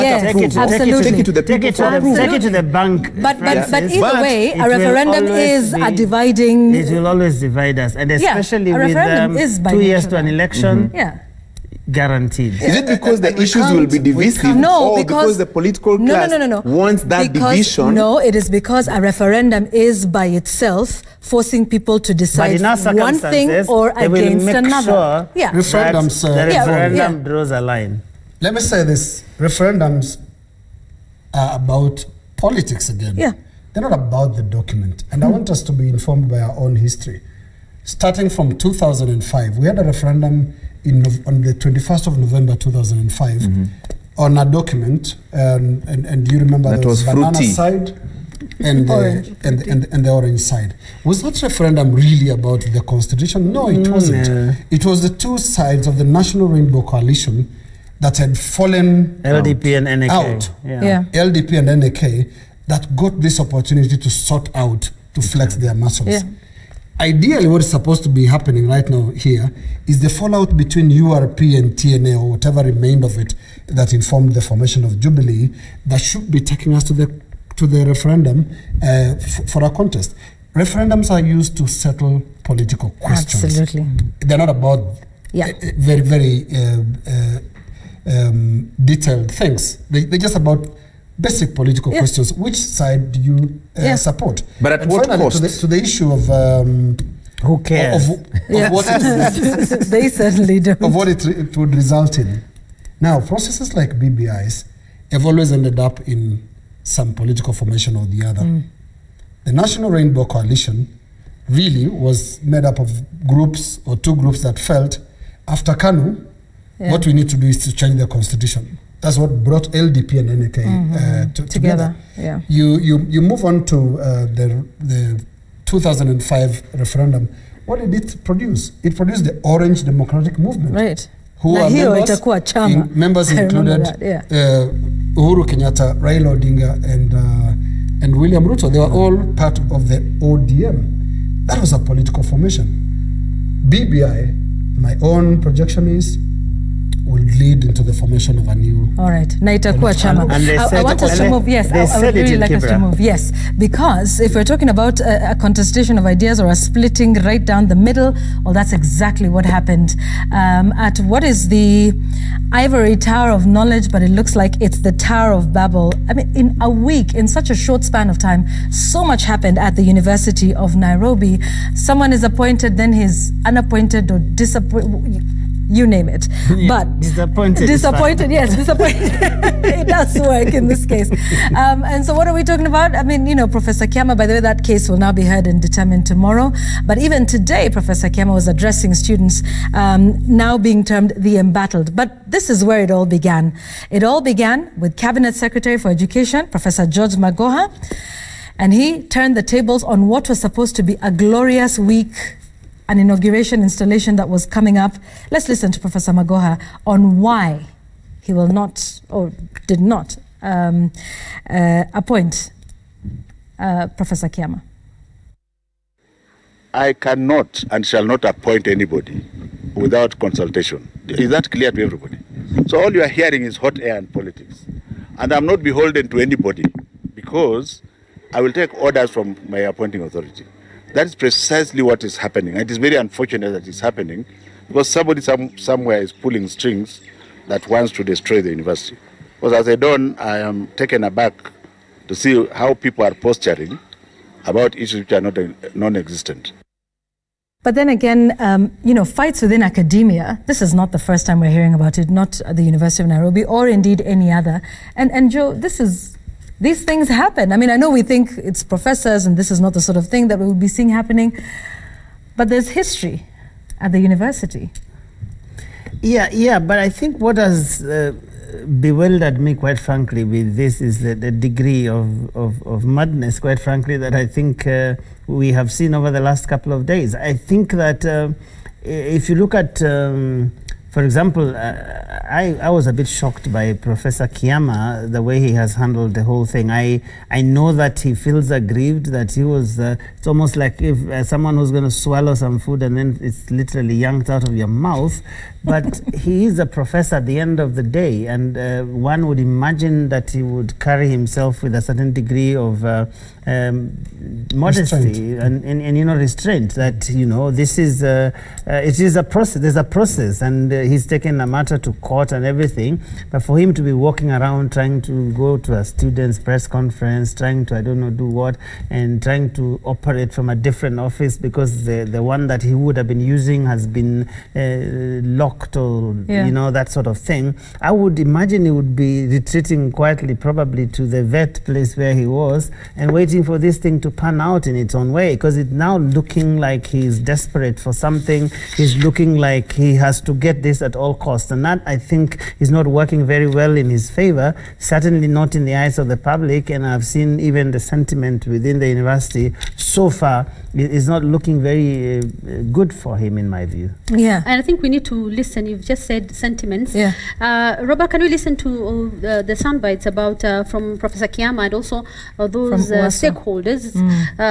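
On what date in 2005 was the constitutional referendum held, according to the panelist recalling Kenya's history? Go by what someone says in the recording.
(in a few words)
21st of November.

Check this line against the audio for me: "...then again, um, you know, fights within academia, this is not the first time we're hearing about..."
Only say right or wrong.
right.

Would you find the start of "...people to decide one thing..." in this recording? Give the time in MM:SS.
00:21.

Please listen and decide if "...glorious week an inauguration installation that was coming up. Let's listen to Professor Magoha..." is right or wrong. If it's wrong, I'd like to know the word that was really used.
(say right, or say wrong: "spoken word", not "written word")
right.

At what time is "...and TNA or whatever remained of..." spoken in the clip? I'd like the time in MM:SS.
01:11.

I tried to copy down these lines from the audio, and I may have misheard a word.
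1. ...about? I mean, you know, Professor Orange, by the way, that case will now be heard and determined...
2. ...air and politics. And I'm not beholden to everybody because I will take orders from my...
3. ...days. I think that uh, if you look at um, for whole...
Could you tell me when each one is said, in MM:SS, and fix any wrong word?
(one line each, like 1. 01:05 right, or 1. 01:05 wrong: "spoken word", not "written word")
1. 03:02 wrong: "Kiama", not "Orange"
2. 03:43 wrong: "anybody", not "everybody"
3. 04:36 wrong: "example", not "whole".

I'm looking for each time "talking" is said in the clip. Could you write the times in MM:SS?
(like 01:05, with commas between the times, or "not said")
02:34, 03:02.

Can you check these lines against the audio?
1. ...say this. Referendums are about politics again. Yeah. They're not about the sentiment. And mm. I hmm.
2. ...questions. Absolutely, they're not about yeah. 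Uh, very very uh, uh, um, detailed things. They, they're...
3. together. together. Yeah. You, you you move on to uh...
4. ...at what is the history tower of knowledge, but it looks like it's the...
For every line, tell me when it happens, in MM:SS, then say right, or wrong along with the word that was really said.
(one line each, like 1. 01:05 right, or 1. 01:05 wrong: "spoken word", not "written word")
1. 00:28 wrong: "document", not "sentiment"
2. 01:22 right
3. 02:01 right
4. 02:40 wrong: "ivory", not "history".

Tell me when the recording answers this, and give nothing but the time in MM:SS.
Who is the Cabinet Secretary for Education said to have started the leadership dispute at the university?
03:16.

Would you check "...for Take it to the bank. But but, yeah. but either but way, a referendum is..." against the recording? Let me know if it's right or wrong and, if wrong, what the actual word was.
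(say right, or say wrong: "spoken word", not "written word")
right.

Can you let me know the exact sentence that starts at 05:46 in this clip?
And I've seen even the sentiment within the university so far is not looking very uh, good for him, in my view.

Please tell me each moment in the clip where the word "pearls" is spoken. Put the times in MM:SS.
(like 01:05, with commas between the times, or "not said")
not said.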